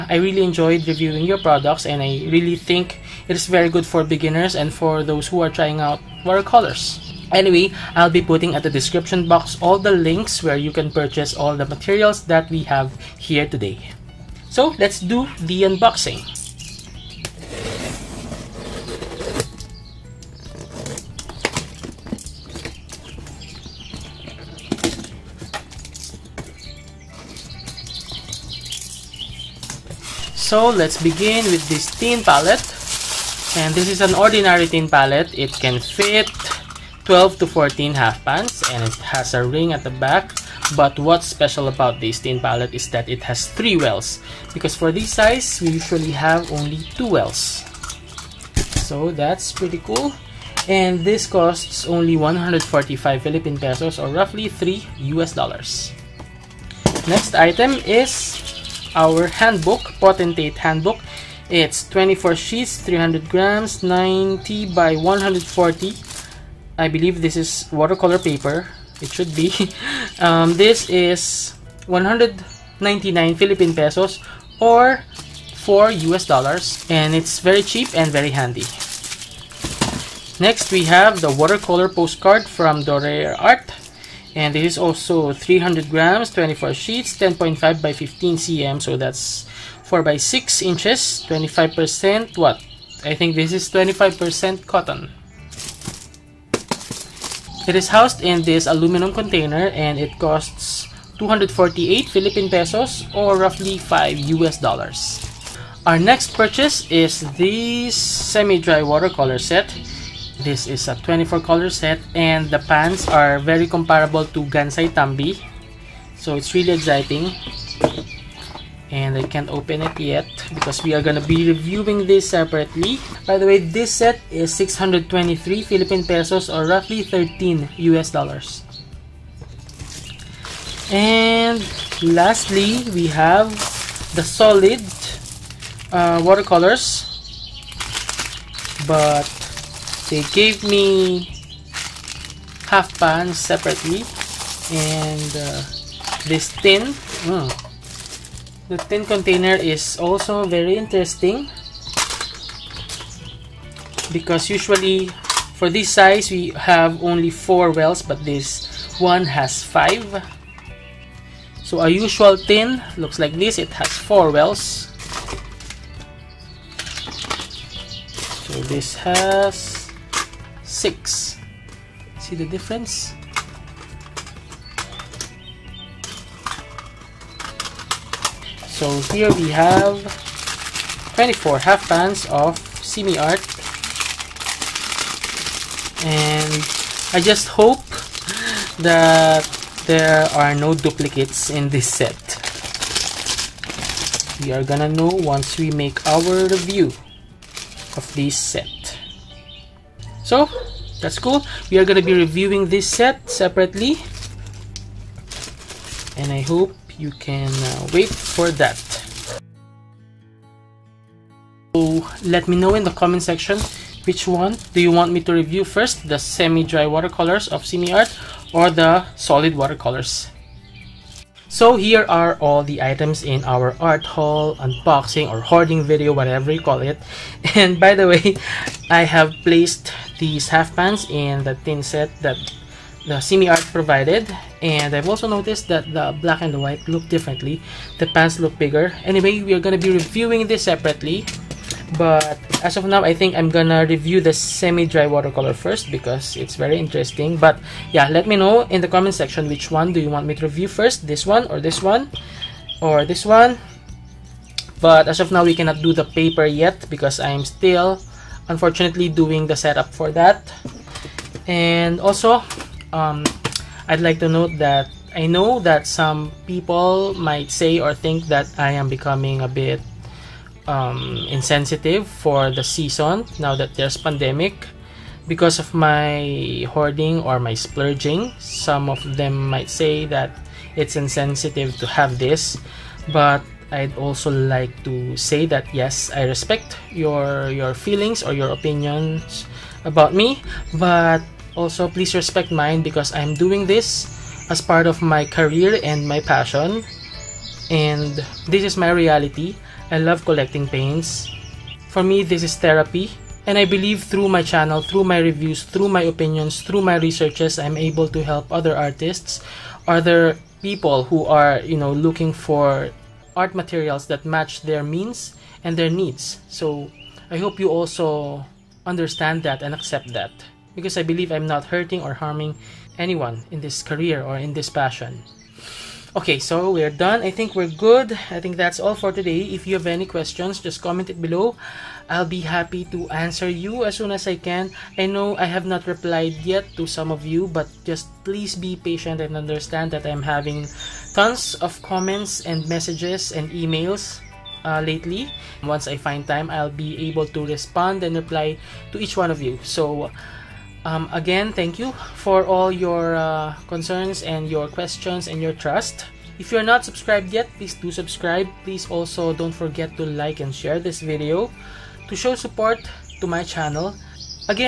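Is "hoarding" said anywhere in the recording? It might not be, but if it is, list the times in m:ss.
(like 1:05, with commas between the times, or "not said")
3:45, 4:36.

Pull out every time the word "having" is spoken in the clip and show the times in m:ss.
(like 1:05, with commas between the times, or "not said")
5:40.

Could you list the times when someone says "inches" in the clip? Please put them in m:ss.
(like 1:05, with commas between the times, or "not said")
1:30.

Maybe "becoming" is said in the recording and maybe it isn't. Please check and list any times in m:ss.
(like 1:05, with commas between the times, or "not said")
4:28.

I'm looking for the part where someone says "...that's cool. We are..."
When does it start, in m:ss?
3:21.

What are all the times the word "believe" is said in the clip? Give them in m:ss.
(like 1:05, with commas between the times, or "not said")
1:06, 5:03, 5:21.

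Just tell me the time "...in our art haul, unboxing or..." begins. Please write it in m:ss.
3:43.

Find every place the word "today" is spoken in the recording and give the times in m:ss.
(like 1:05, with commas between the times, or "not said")
0:13, 5:29.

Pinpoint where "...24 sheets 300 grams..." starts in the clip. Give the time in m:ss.
1:01.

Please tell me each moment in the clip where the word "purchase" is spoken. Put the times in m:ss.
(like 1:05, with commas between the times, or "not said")
0:10, 1:46.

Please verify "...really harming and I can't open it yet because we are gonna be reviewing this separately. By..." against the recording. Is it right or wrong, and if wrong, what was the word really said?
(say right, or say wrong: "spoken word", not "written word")
wrong: "exciting", not "harming".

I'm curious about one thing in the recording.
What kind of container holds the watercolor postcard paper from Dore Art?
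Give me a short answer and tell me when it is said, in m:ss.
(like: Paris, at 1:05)
aluminum container, at 1:38.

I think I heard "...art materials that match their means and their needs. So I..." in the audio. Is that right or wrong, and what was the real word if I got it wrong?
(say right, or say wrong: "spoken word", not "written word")
right.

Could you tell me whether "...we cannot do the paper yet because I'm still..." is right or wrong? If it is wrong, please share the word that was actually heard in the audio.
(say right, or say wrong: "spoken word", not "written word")
right.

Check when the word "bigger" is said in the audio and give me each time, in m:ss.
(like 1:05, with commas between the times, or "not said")
3:58.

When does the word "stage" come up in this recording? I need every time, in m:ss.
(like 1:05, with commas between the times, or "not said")
not said.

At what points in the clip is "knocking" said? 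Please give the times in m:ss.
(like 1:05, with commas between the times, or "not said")
not said.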